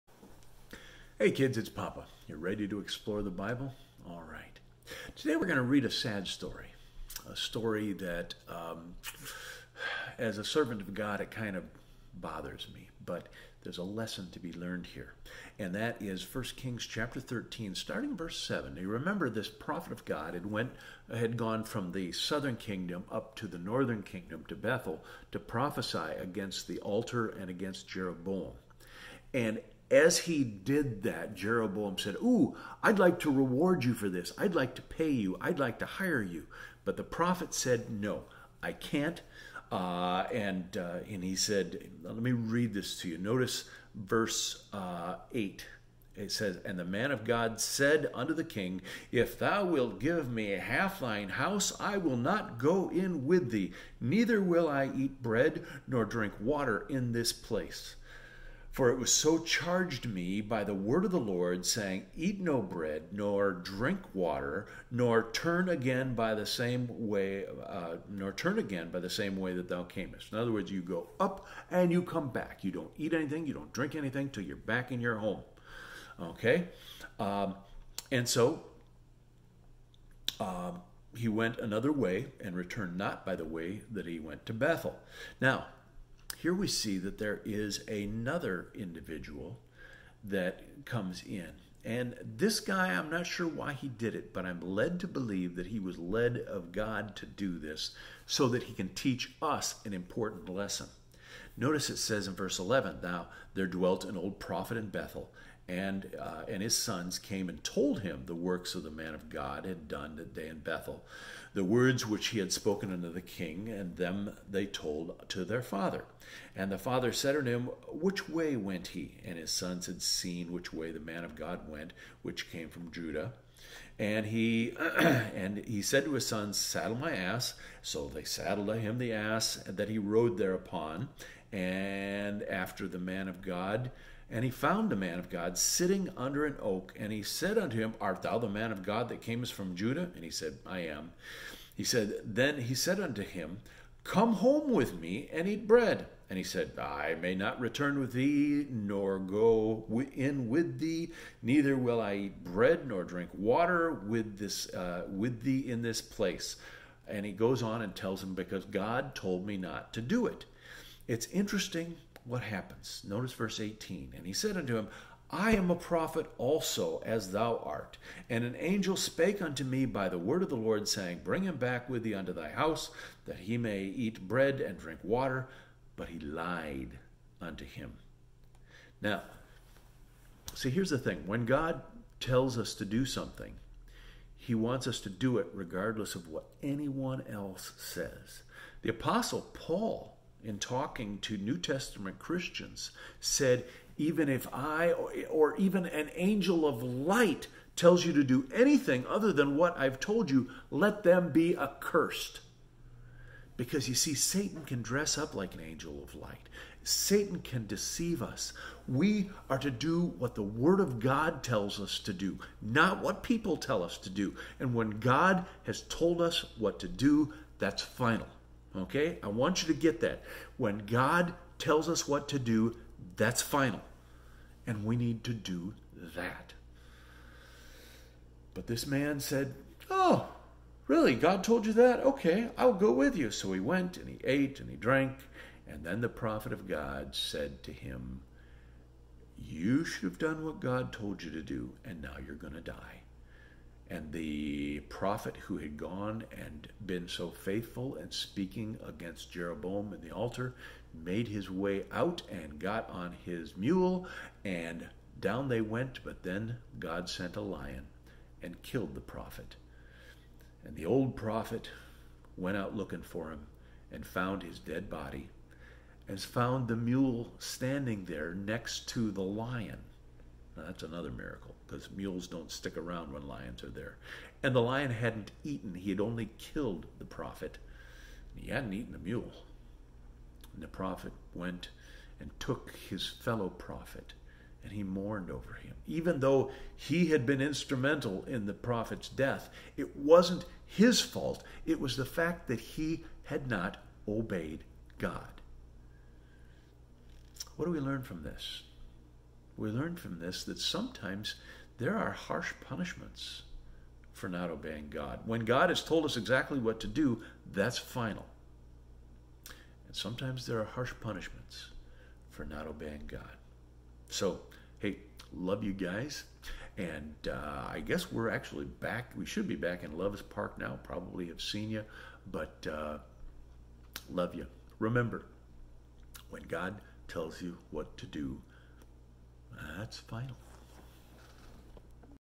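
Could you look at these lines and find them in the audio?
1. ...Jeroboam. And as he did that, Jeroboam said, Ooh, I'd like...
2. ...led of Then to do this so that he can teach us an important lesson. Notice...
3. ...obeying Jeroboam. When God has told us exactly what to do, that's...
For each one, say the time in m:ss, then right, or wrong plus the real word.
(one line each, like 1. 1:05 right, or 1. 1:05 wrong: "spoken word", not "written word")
1. 0:27 right
2. 1:35 wrong: "God", not "Then"
3. 5:04 wrong: "God", not "Jeroboam".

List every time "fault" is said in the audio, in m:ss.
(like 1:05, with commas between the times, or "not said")
4:51.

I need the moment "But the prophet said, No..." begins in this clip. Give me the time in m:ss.
0:36.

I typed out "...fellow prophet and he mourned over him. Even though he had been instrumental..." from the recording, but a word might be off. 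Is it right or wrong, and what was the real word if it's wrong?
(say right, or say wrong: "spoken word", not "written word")
right.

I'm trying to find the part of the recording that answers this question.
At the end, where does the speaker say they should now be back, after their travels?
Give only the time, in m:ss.
5:19.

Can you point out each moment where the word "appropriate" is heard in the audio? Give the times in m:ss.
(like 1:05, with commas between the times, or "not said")
not said.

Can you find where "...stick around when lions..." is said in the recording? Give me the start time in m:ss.
4:32.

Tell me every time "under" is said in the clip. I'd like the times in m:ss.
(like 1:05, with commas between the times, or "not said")
2:16.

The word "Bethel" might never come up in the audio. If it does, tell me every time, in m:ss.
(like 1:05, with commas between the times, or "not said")
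0:24, 1:24, 1:44, 1:50.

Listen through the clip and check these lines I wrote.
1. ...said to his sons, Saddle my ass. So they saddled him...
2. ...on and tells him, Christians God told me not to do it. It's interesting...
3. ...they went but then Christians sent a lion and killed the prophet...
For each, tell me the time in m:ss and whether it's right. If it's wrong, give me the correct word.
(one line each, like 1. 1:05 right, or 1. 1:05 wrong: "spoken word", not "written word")
1. 2:05 right
2. 2:37 wrong: "Because", not "Christians"
3. 4:15 wrong: "God", not "Christians".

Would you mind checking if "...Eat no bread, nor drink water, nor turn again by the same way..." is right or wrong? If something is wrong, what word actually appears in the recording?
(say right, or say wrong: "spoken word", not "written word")
right.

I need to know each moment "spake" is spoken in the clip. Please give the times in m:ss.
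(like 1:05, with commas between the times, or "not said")
2:48.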